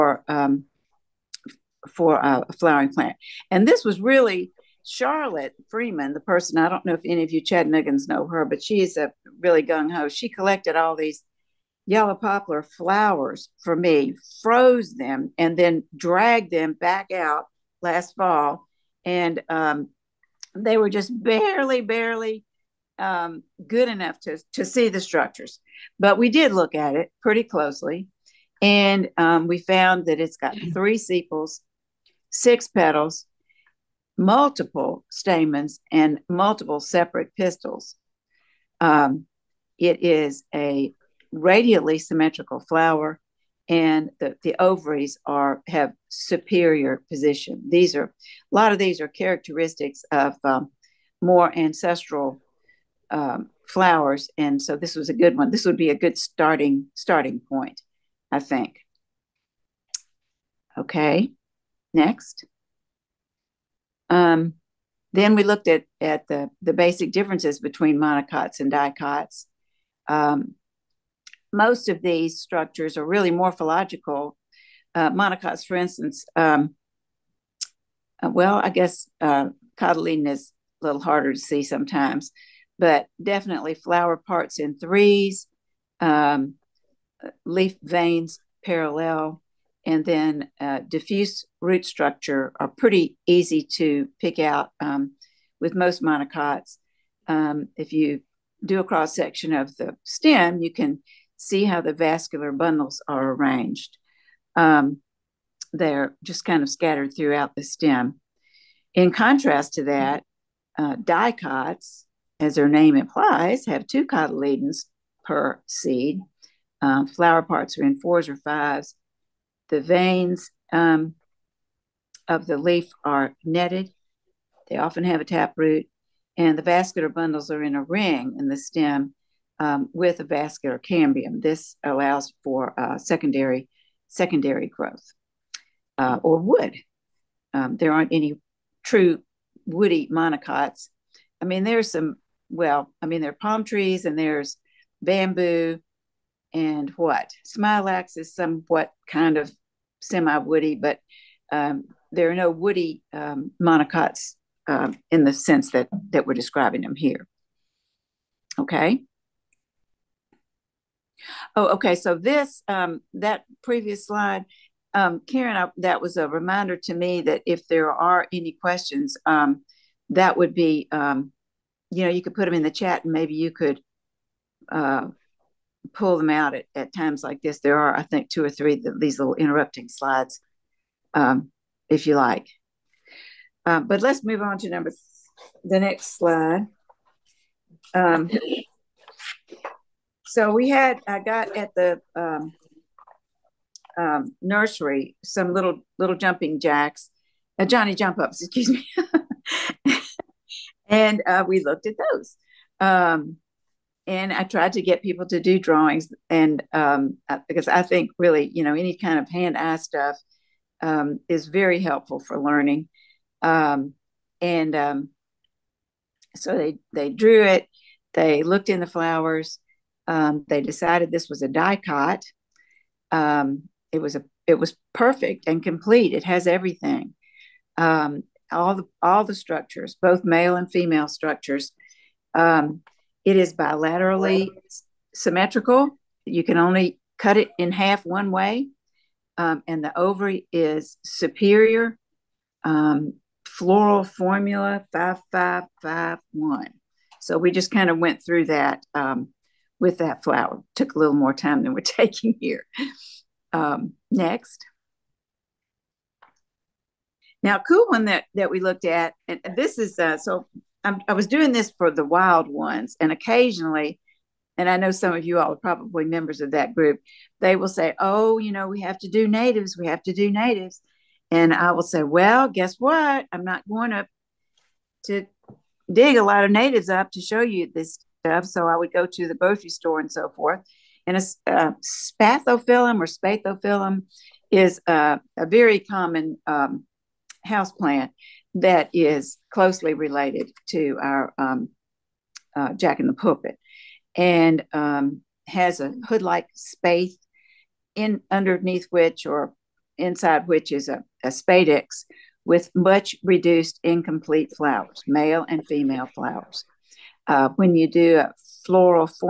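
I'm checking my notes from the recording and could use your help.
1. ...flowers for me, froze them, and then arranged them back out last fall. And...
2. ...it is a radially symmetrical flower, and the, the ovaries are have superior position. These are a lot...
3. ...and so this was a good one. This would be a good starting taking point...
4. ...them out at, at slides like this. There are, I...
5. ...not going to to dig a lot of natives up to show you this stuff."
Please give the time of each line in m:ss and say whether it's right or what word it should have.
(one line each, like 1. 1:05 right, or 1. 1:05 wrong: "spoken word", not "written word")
1. 0:12 wrong: "dragged", not "arranged"
2. 0:39 right
3. 0:54 wrong: "starting", not "taking"
4. 2:56 wrong: "times", not "slides"
5. 4:33 right.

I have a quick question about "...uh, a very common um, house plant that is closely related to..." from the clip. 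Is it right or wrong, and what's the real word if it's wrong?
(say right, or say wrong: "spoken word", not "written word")
right.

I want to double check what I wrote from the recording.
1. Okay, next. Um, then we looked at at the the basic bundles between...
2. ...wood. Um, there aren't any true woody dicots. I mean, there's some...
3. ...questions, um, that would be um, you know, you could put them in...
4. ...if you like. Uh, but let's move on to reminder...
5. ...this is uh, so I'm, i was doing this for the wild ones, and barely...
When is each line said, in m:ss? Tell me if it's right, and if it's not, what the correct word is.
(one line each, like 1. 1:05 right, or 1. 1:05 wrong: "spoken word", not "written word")
1. 1:00 wrong: "differences", not "bundles"
2. 2:16 wrong: "monocots", not "dicots"
3. 2:48 right
4. 3:01 wrong: "number", not "reminder"
5. 4:19 wrong: "occasionally", not "barely".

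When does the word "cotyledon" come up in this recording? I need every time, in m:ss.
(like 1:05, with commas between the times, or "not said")
1:19, 1:54.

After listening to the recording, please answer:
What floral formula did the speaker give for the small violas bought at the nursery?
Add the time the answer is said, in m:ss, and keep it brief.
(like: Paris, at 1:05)
5 5 5 1, at 4:04.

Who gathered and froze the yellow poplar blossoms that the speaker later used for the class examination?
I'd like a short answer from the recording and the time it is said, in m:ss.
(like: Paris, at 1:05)
Charlotte Freeman, at 0:04.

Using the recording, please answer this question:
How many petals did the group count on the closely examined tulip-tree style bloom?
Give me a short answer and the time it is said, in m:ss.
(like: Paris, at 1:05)
6, at 0:32.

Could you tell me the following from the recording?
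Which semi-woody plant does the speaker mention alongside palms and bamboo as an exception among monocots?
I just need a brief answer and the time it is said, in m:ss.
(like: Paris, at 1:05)
Smilax, at 2:27.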